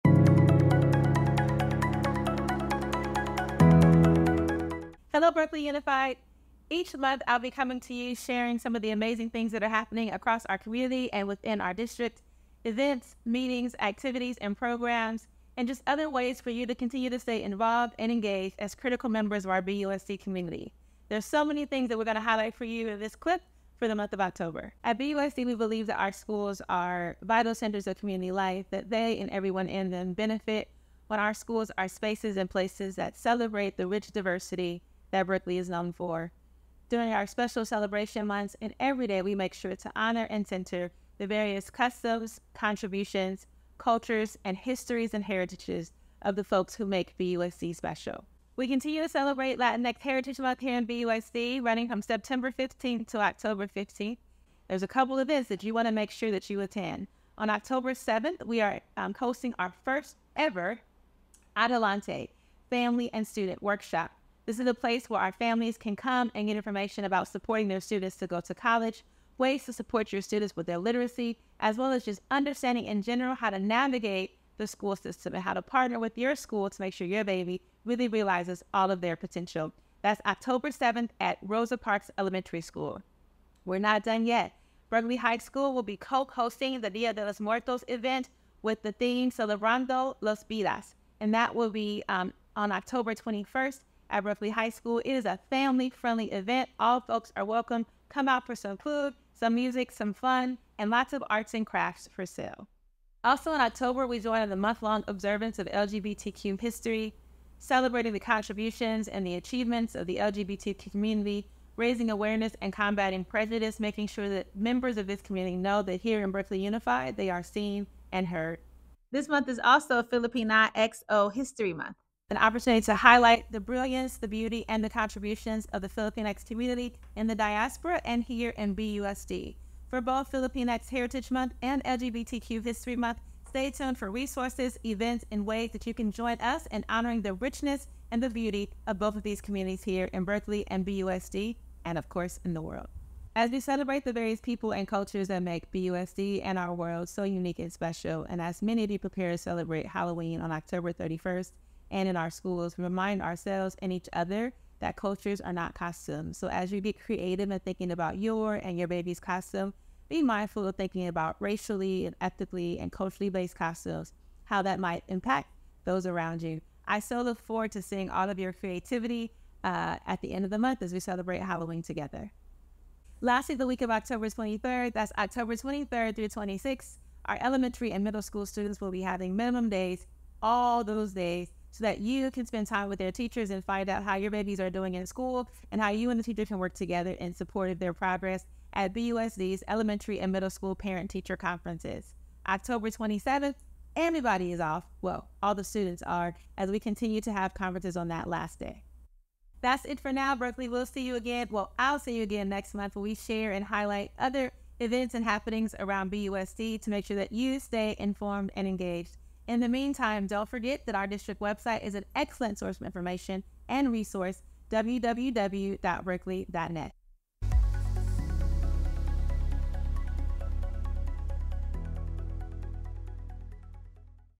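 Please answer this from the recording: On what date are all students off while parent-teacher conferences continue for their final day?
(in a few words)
October 27th.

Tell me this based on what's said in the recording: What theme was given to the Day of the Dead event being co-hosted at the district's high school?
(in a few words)
Celebrando los Vidas.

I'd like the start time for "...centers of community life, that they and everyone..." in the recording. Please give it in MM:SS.
00:27.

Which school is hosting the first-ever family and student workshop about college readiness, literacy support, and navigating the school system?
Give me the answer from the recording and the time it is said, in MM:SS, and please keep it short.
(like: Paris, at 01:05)
Rosa Parks Elementary School, at 01:21.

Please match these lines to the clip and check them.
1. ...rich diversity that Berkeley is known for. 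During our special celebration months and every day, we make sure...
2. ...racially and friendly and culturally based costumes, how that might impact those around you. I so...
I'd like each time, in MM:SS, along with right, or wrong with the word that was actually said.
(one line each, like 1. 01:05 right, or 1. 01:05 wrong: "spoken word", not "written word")
1. 00:33 right
2. 02:41 wrong: "ethically", not "friendly".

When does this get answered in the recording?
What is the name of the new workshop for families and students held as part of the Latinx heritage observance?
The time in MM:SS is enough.
01:01.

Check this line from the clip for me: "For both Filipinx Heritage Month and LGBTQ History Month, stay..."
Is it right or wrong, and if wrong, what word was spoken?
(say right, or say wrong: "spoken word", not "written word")
right.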